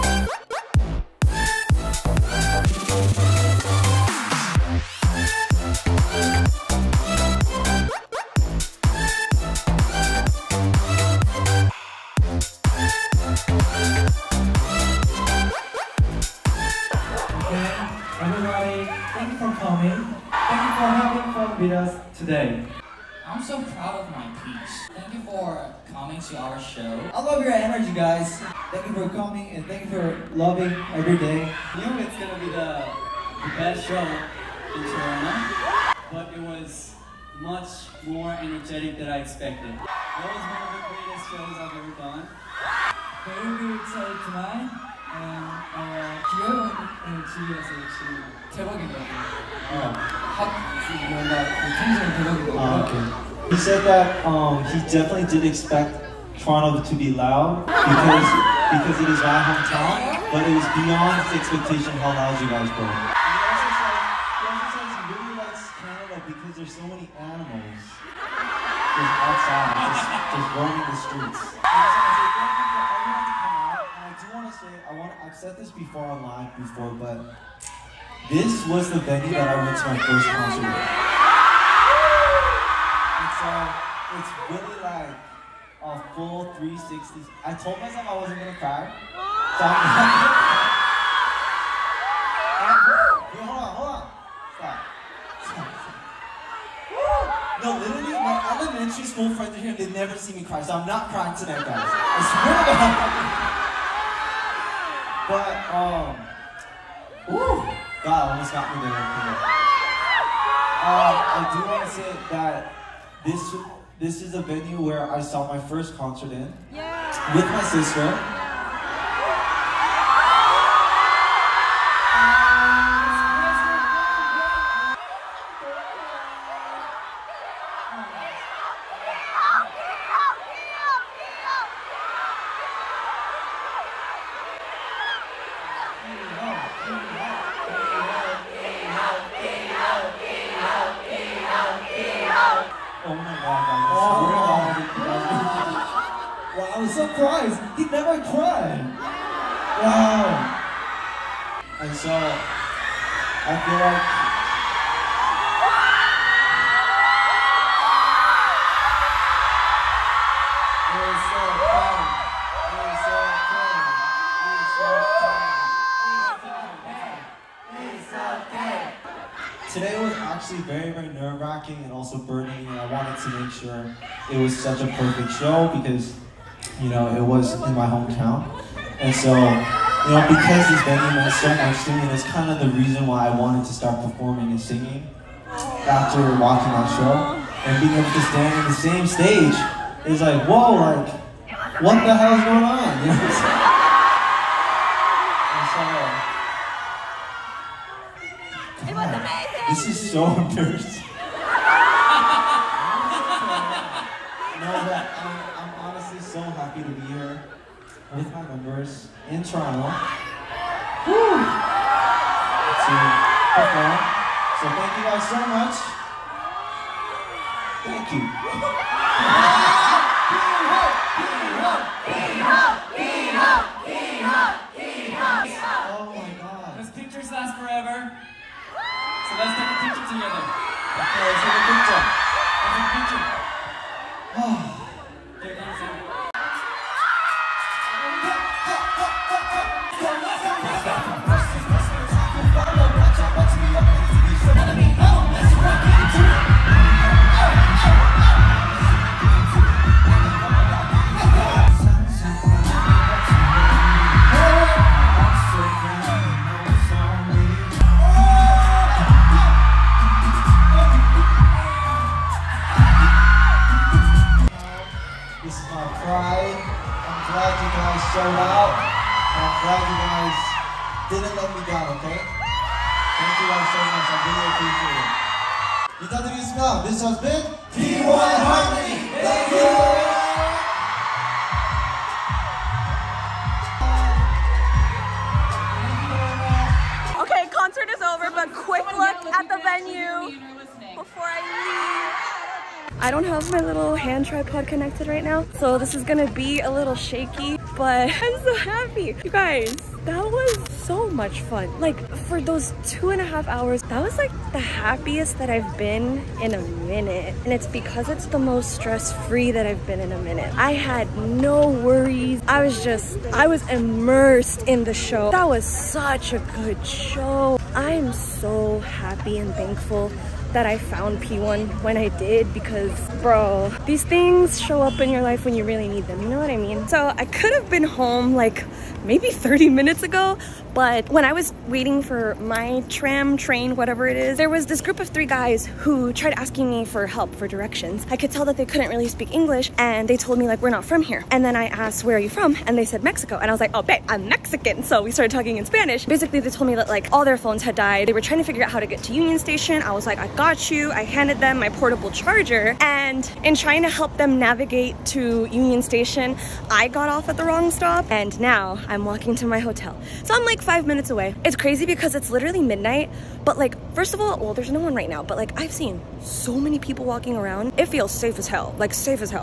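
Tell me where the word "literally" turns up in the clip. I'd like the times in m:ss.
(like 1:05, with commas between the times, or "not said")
1:37, 6:02.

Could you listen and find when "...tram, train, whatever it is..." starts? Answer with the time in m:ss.
5:32.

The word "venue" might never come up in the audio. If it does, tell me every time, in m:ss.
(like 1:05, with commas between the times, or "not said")
1:19, 1:54, 3:00.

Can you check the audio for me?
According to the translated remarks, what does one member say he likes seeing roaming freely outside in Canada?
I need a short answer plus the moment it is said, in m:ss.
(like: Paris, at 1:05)
Animals, at 1:07.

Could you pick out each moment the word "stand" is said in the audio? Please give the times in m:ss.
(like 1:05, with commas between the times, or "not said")
3:08.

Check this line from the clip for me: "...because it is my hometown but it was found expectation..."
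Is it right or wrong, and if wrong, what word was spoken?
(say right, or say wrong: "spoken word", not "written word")
wrong: "beyond", not "found".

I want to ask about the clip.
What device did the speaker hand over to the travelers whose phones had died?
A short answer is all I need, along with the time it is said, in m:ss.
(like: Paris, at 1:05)
Portable charger, at 5:51.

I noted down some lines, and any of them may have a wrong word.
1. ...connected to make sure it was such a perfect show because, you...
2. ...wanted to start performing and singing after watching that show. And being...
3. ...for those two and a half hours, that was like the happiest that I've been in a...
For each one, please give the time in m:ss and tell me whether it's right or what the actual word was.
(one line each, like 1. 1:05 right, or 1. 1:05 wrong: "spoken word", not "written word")
1. 2:52 wrong: "wanted", not "connected"
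2. 3:03 right
3. 5:02 right.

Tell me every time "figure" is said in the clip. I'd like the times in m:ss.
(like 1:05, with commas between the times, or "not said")
5:48.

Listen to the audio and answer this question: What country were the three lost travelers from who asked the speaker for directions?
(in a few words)
Mexico.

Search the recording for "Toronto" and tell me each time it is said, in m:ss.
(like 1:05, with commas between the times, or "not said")
0:34, 0:56, 3:29.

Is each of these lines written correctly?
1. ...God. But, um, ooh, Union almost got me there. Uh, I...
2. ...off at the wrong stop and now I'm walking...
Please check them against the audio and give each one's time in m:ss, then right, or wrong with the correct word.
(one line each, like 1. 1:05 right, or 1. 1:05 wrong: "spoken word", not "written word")
1. 1:45 wrong: "God", not "Union"
2. 5:57 right.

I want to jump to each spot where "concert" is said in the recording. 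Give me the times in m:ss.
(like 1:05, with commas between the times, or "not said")
1:20, 1:55.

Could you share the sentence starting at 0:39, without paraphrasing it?
That was one of the greatest shows I've ever done.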